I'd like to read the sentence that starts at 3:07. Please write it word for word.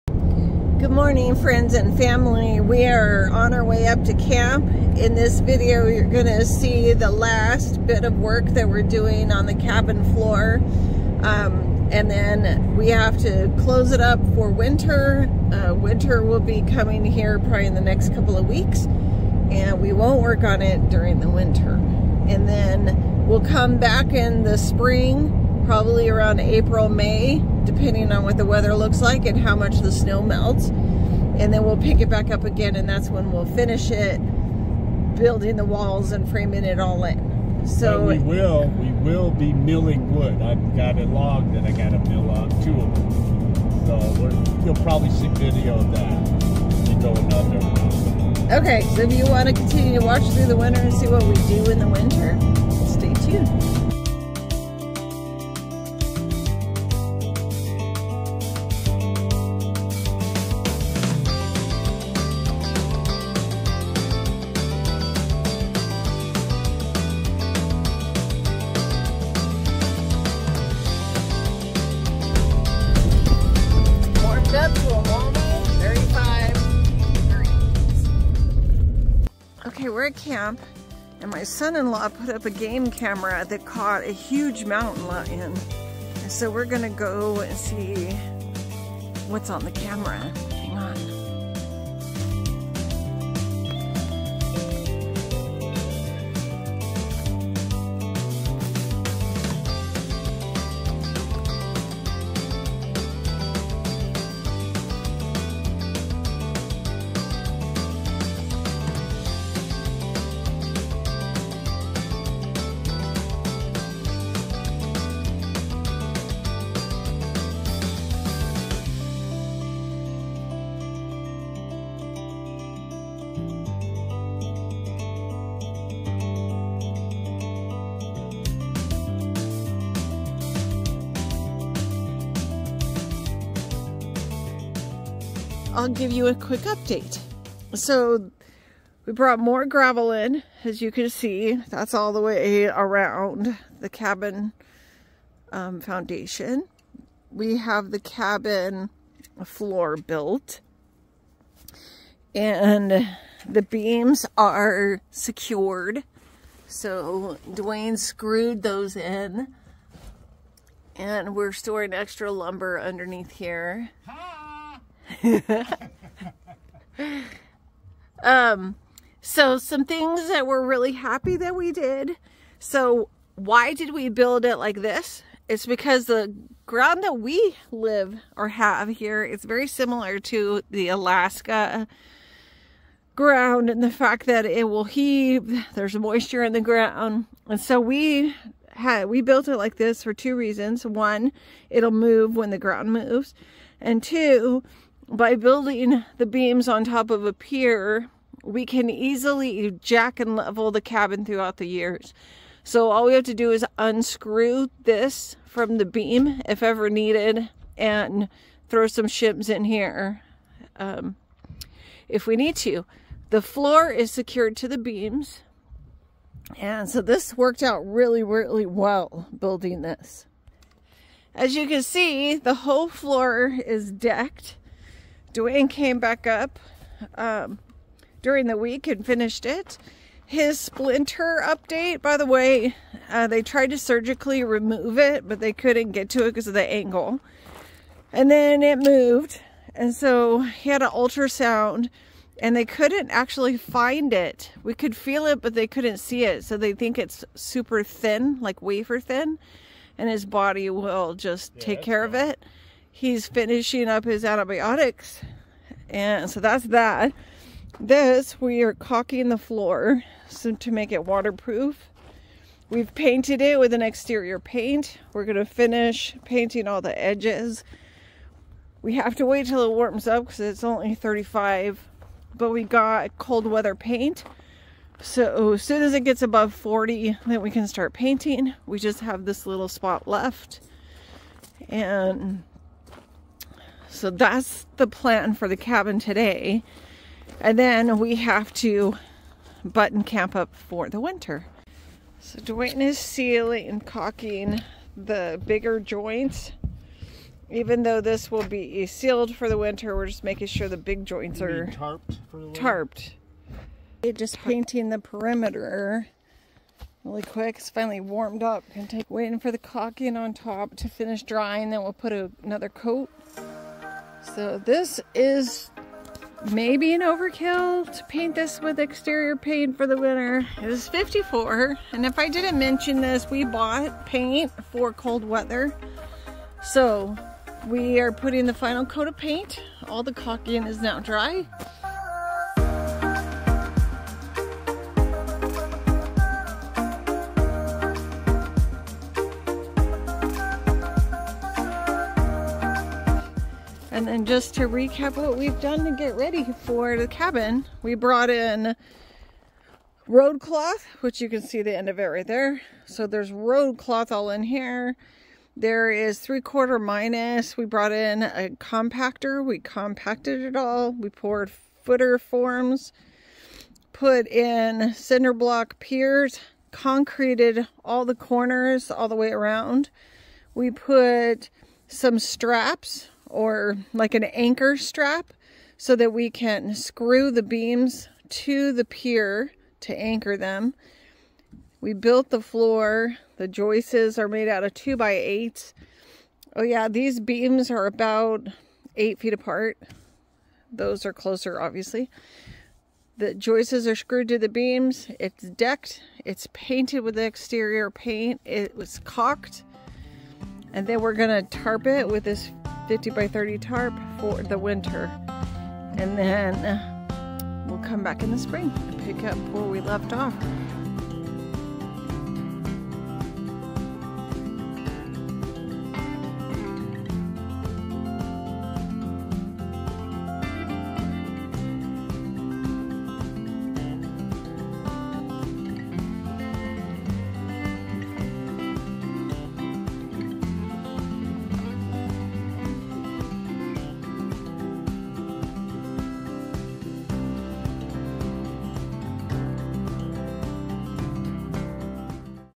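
And so we had, we built it like this for two reasons.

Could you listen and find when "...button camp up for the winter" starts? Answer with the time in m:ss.
4:49.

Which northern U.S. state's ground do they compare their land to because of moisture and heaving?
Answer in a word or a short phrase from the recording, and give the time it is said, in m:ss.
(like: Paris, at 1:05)
Alaska, at 3:00.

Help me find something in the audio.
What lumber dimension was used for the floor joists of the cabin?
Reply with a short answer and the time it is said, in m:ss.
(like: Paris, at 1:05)
2 by 8, at 6:24.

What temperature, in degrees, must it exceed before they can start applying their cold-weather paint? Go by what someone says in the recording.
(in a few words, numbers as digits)
40.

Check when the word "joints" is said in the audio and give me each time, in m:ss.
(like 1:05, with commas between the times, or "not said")
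4:55, 5:01.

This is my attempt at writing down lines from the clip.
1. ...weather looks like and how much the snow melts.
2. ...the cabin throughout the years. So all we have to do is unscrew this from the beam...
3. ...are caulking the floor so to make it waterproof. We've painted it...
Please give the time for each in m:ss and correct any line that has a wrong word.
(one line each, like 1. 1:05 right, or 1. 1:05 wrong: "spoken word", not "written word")
1. 0:28 right
2. 3:20 right
3. 4:18 right.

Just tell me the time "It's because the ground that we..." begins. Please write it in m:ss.
2:55.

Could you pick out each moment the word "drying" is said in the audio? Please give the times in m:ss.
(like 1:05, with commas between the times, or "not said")
5:11.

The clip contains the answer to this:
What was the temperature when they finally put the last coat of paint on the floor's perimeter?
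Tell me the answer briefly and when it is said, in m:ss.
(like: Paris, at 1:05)
54, at 5:20.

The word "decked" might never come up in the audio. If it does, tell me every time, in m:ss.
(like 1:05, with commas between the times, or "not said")
3:43, 6:35.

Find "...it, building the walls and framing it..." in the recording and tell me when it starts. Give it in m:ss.
0:33.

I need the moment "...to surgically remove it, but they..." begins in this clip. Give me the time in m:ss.
3:53.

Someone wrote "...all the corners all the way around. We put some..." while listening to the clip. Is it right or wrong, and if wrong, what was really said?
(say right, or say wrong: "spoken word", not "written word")
right.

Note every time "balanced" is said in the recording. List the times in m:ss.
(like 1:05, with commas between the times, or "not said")
not said.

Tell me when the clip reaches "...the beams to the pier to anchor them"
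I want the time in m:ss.
6:17.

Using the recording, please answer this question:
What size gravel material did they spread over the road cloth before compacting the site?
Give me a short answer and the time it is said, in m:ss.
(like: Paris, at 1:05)
Three quarter minus, at 5:56.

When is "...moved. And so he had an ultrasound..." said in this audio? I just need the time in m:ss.
3:58.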